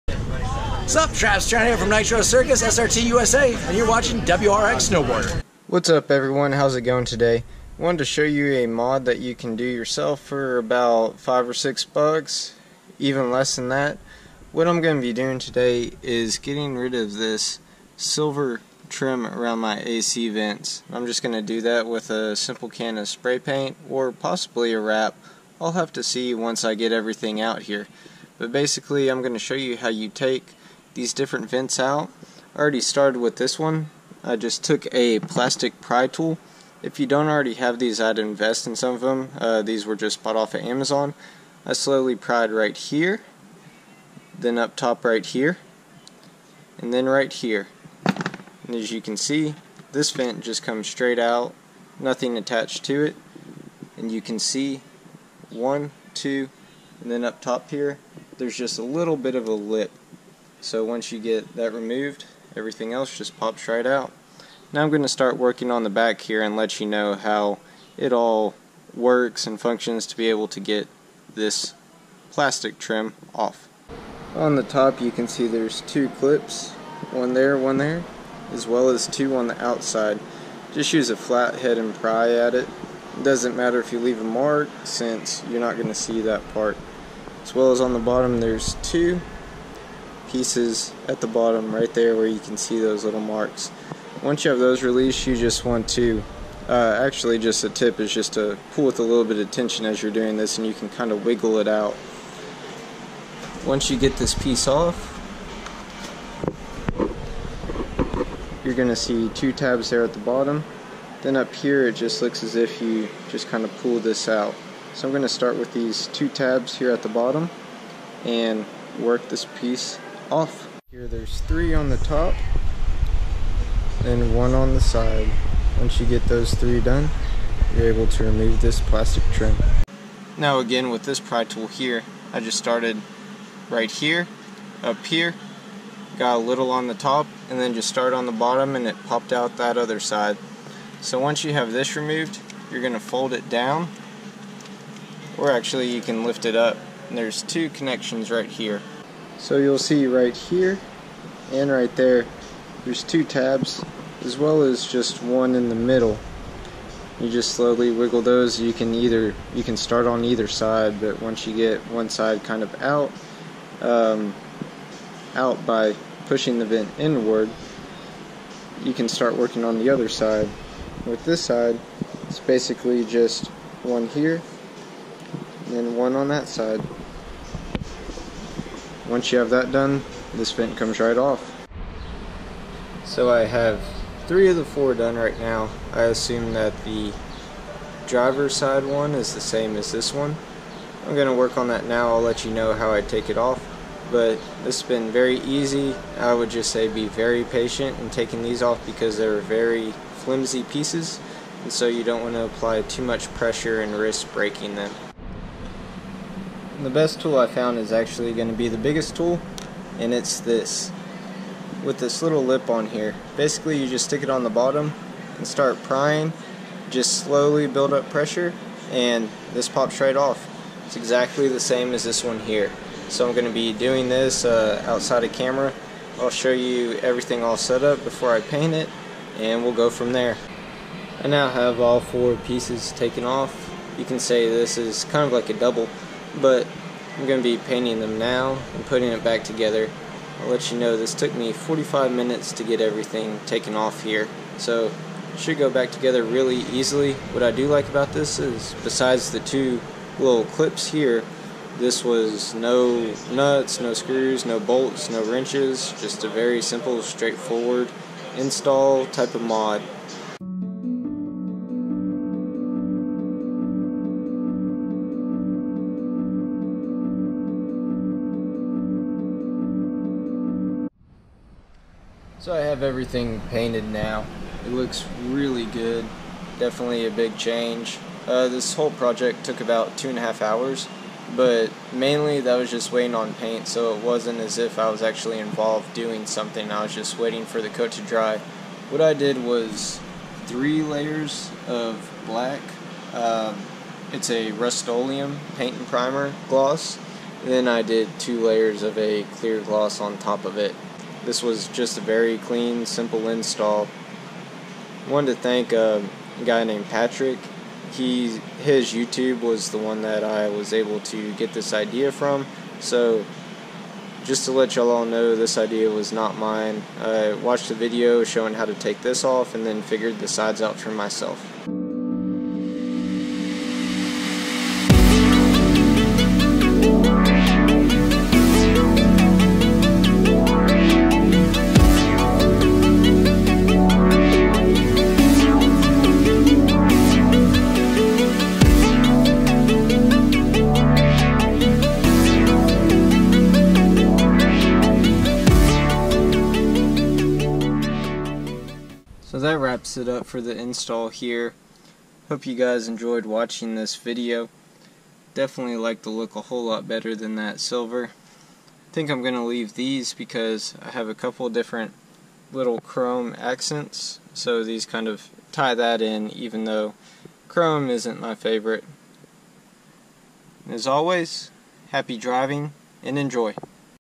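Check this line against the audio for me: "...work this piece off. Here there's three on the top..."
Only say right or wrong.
right.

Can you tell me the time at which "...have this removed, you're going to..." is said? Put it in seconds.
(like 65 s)
141 s.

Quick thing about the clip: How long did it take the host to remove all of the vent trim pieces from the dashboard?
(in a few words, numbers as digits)
45 minutes.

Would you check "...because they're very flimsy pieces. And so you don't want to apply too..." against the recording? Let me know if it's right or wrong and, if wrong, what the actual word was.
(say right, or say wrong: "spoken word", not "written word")
right.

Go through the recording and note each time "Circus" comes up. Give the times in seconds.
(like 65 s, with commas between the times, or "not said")
2 s.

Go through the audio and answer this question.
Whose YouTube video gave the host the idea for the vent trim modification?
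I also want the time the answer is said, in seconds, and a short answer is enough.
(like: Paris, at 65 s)
Patrick, at 306 s.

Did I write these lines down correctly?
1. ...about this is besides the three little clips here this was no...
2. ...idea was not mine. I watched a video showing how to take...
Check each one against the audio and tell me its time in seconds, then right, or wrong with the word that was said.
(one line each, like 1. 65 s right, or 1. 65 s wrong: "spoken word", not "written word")
1. 247 s wrong: "two", not "three"
2. 315 s right.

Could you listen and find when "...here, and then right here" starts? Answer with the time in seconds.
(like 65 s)
45 s.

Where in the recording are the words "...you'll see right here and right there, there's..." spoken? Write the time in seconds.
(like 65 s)
149 s.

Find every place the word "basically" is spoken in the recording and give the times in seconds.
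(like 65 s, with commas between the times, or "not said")
28 s, 172 s, 213 s.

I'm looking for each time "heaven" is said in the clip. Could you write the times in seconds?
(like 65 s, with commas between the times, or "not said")
not said.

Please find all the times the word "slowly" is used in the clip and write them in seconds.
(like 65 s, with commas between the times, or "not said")
41 s, 157 s, 217 s.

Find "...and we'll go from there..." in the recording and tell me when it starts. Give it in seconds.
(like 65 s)
229 s.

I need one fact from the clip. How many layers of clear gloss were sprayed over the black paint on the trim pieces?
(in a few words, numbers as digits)
2.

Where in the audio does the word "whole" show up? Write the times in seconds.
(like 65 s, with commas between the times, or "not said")
278 s, 356 s.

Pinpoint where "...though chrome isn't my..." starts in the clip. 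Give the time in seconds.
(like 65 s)
366 s.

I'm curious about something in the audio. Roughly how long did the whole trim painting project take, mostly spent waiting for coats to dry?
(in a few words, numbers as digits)
2.5 hours.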